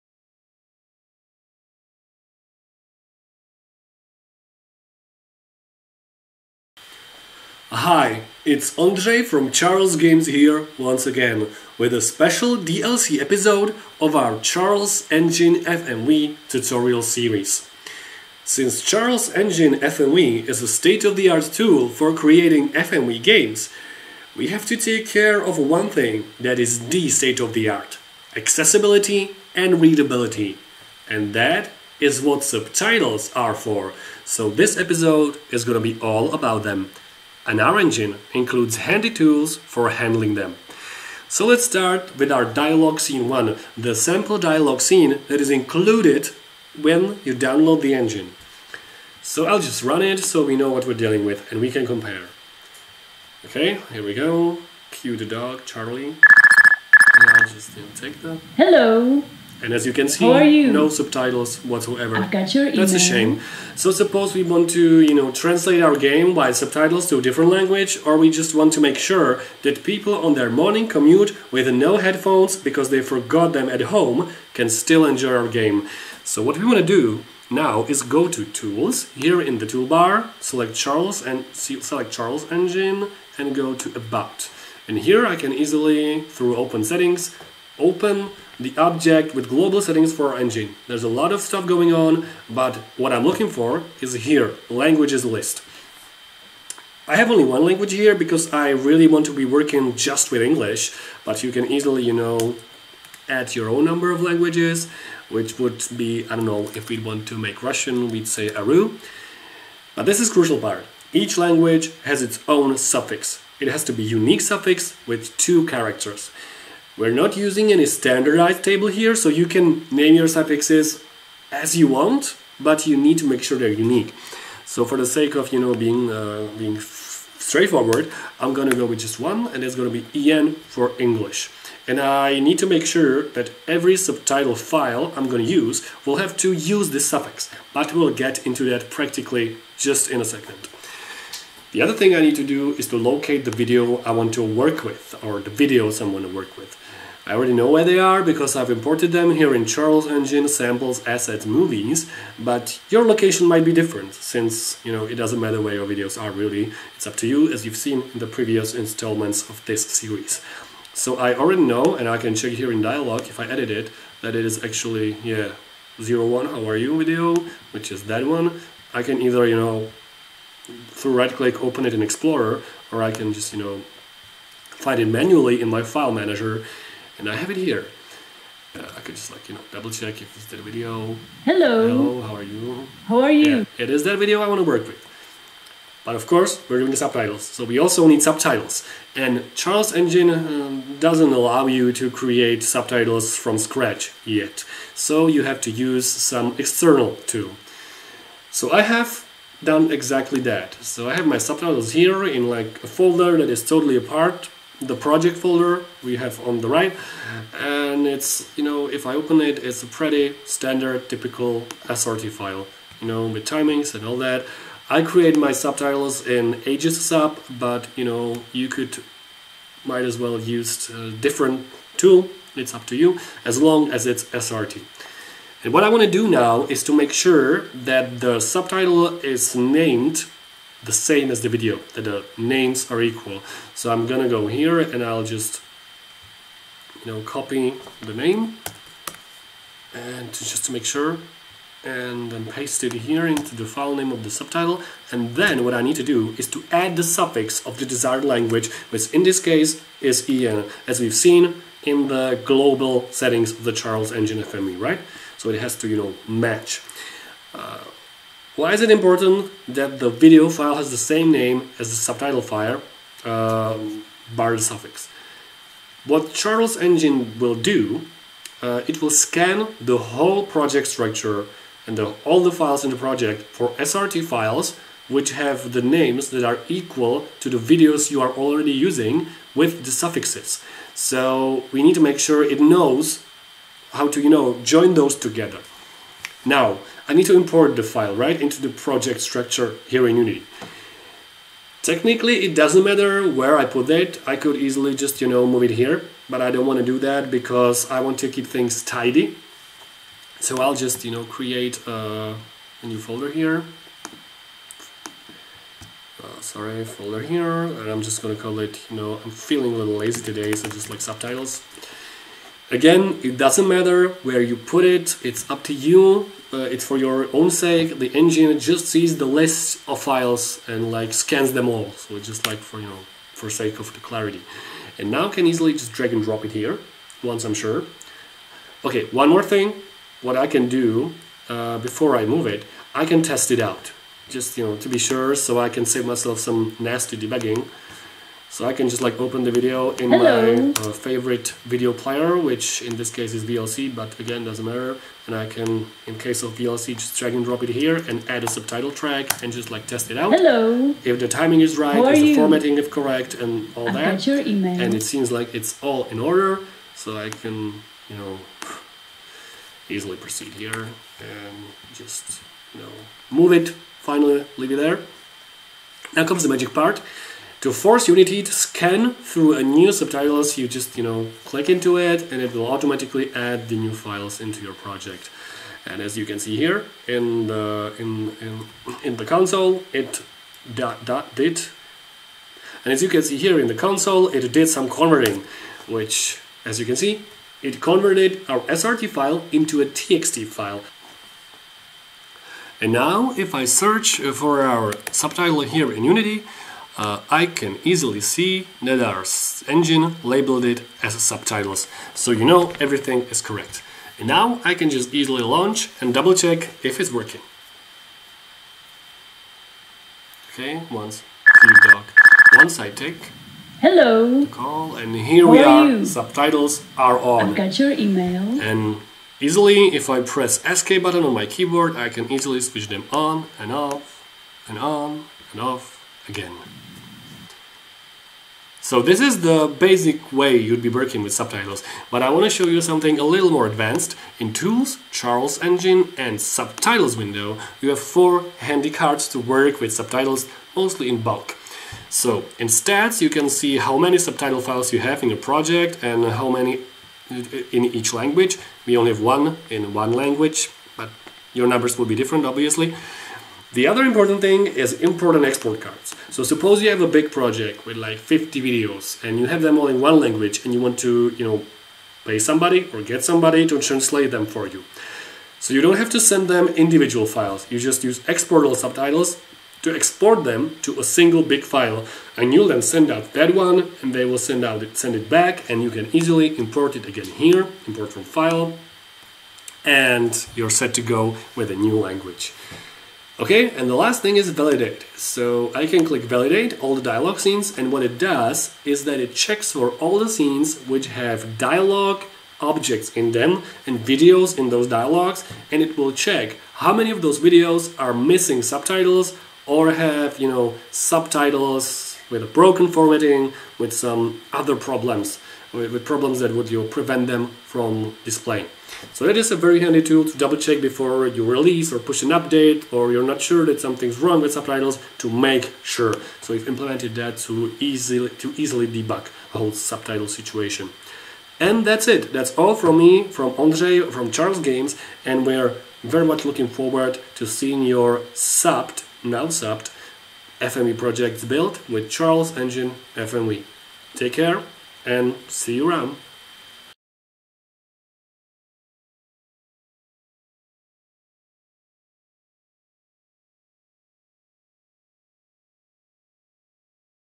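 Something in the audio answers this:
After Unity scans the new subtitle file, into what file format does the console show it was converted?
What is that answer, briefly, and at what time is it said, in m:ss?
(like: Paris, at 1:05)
TXT, at 6:29.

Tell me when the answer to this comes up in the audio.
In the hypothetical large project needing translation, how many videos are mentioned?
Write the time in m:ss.
7:38.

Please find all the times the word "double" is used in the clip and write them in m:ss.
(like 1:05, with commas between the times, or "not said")
2:59, 6:46, 8:30.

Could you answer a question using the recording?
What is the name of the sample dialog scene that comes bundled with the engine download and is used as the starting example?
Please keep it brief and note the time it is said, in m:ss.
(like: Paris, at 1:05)
dialog scene 1, at 0:42.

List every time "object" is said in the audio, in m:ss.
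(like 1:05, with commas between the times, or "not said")
1:28, 8:12.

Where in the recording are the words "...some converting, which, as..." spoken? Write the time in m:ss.
6:24.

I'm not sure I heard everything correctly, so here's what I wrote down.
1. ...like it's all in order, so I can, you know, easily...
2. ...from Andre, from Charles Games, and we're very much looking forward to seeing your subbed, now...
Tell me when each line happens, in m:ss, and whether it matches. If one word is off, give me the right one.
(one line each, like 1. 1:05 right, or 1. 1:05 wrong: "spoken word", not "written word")
1. 5:55 right
2. 8:43 right.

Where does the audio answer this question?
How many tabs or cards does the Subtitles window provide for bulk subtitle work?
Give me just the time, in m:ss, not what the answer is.
7:18.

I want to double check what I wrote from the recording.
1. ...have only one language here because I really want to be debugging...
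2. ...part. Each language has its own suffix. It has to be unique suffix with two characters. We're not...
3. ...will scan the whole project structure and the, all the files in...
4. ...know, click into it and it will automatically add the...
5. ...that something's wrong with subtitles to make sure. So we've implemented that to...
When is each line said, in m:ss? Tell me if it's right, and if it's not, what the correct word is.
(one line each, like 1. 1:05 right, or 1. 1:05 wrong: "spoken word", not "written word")
1. 1:37 wrong: "working", not "debugging"
2. 1:50 right
3. 4:29 right
4. 6:11 right
5. 8:33 right.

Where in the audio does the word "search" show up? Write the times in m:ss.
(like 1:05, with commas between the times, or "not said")
6:33.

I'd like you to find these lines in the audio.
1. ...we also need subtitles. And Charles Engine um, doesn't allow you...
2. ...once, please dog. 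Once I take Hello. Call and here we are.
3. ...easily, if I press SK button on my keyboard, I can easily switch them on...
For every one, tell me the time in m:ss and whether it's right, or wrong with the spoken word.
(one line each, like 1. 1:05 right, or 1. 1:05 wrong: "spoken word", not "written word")
1. 3:07 right
2. 6:50 right
3. 6:59 right.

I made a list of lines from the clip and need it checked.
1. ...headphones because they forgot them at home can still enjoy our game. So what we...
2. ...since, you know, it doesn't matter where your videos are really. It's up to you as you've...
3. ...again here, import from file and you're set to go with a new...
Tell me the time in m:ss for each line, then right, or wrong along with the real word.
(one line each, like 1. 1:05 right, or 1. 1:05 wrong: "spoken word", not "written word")
1. 1:11 right
2. 2:34 right
3. 7:57 right.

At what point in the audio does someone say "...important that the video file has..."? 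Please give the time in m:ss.
4:18.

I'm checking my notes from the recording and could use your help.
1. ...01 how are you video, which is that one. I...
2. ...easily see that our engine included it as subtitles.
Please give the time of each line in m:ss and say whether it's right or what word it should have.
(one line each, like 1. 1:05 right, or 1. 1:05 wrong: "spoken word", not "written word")
1. 2:45 right
2. 6:37 wrong: "labeled", not "included".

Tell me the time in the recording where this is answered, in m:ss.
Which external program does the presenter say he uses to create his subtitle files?
3:36.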